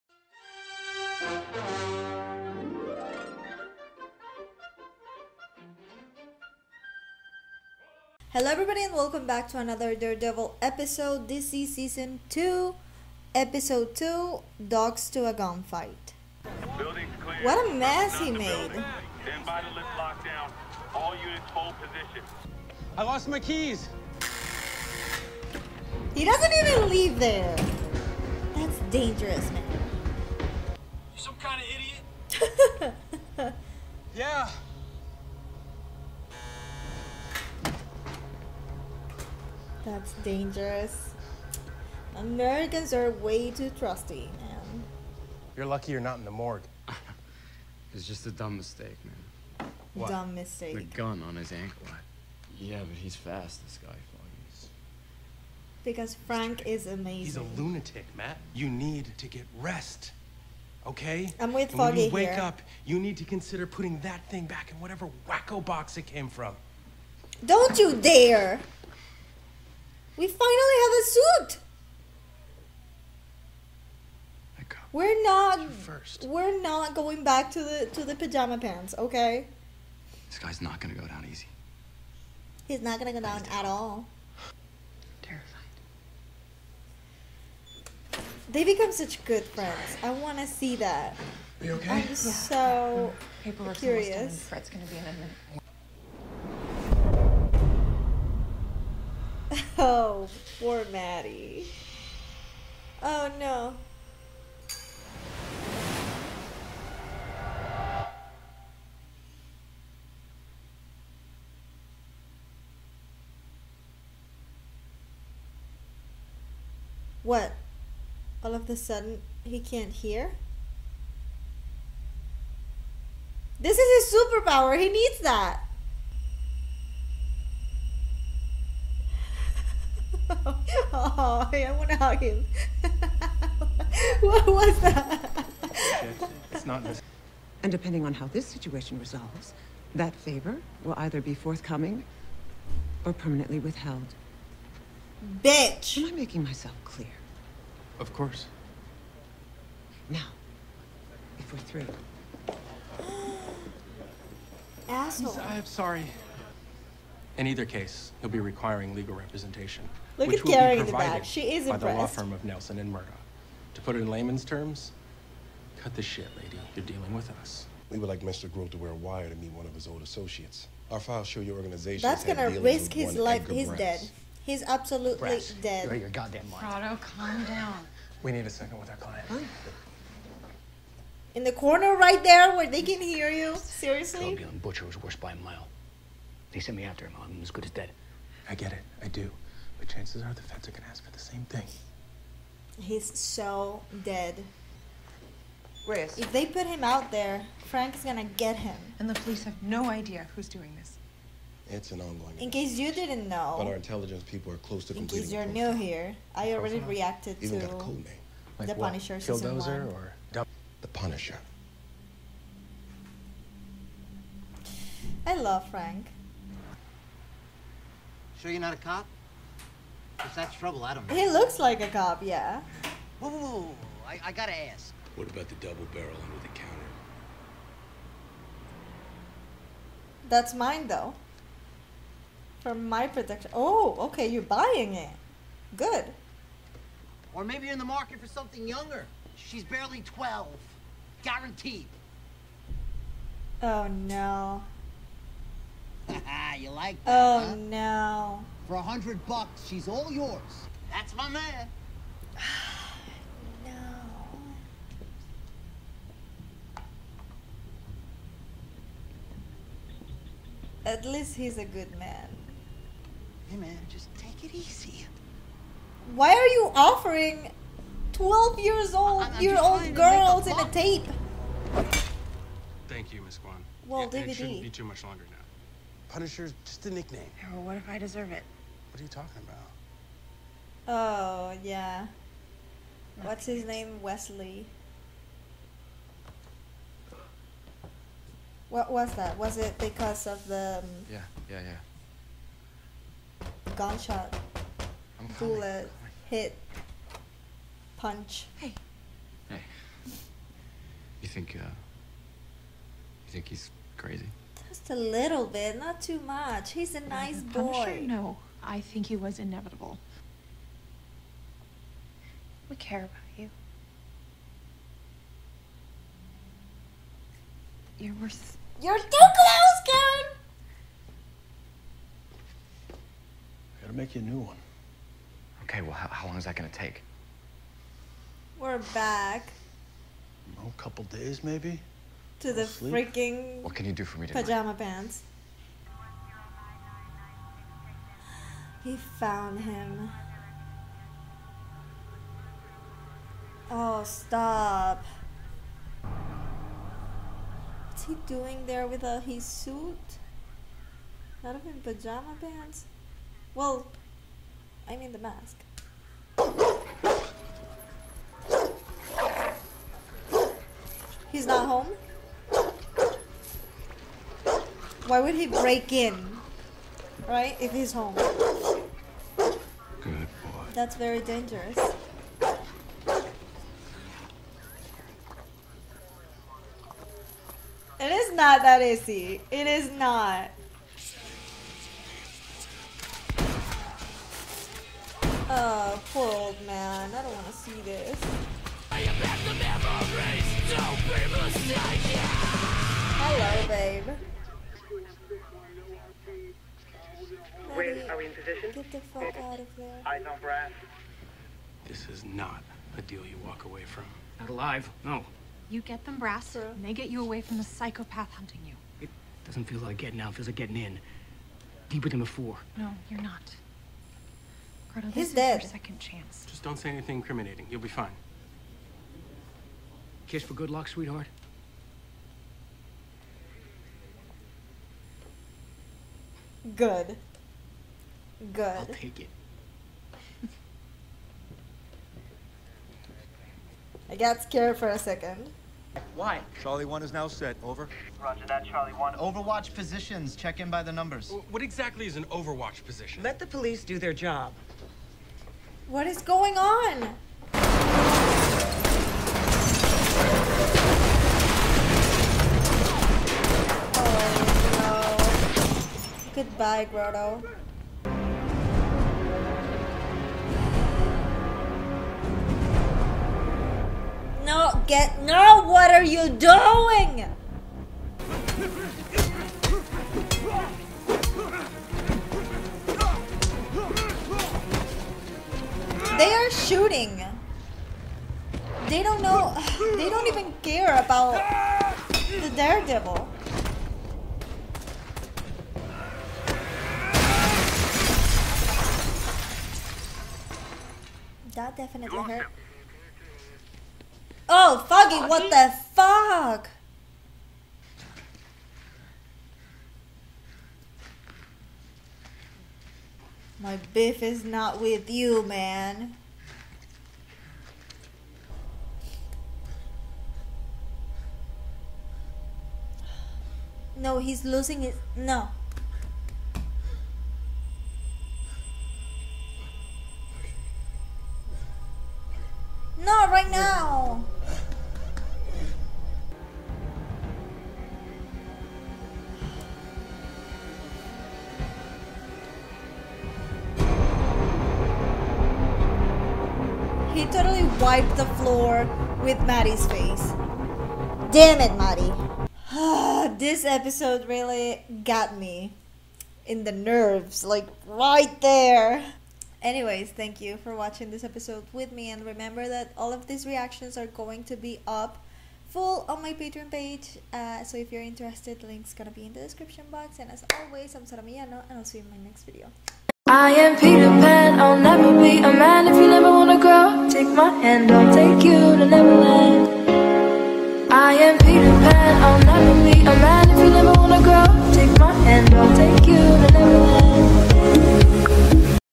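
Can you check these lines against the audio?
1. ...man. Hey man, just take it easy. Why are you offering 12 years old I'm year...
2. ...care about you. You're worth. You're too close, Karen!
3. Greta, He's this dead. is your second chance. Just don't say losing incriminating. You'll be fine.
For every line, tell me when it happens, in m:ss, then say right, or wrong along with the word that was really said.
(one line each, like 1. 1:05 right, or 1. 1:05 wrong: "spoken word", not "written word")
1. 4:21 right
2. 5:12 right
3. 6:54 wrong: "anything", not "losing".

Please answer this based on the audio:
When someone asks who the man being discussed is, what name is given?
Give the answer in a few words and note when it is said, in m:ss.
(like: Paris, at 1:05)
Wesley, at 4:44.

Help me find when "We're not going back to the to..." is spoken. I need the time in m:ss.
1:16.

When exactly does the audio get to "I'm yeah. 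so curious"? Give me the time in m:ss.
1:31.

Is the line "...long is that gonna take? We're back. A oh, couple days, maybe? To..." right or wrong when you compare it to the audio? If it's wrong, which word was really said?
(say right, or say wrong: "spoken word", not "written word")
right.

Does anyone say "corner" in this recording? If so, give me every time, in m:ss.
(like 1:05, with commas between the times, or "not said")
3:01.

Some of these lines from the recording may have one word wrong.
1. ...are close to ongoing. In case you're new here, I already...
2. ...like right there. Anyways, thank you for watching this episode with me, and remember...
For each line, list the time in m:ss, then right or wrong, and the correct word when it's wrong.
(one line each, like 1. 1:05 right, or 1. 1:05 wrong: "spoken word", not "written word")
1. 3:24 wrong: "completing", not "ongoing"
2. 9:07 right.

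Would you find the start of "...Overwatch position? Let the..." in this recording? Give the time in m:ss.
7:22.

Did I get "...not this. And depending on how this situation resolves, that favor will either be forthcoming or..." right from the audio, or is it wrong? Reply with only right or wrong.
right.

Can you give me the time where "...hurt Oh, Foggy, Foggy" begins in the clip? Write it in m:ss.
8:12.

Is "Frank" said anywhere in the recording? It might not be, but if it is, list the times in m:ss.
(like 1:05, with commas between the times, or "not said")
0:56, 3:17, 3:35.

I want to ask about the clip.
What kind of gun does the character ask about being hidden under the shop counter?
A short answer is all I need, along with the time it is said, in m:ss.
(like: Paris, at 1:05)
Double barrel, at 3:45.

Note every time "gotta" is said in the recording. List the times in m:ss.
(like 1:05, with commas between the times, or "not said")
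3:44, 5:23.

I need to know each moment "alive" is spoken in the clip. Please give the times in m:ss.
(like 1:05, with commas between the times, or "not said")
6:44.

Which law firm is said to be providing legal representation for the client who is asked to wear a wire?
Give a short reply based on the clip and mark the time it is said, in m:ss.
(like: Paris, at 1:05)
Nelson and Murdoch, at 2:42.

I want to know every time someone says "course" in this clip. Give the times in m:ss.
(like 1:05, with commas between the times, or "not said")
2:28.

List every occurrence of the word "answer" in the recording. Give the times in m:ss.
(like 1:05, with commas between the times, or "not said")
not said.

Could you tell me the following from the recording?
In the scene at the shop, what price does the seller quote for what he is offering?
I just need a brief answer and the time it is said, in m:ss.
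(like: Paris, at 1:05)
$100, at 4:08.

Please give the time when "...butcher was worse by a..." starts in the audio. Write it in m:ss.
3:04.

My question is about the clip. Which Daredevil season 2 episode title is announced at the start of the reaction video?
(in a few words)
Dogs to a Gunfight.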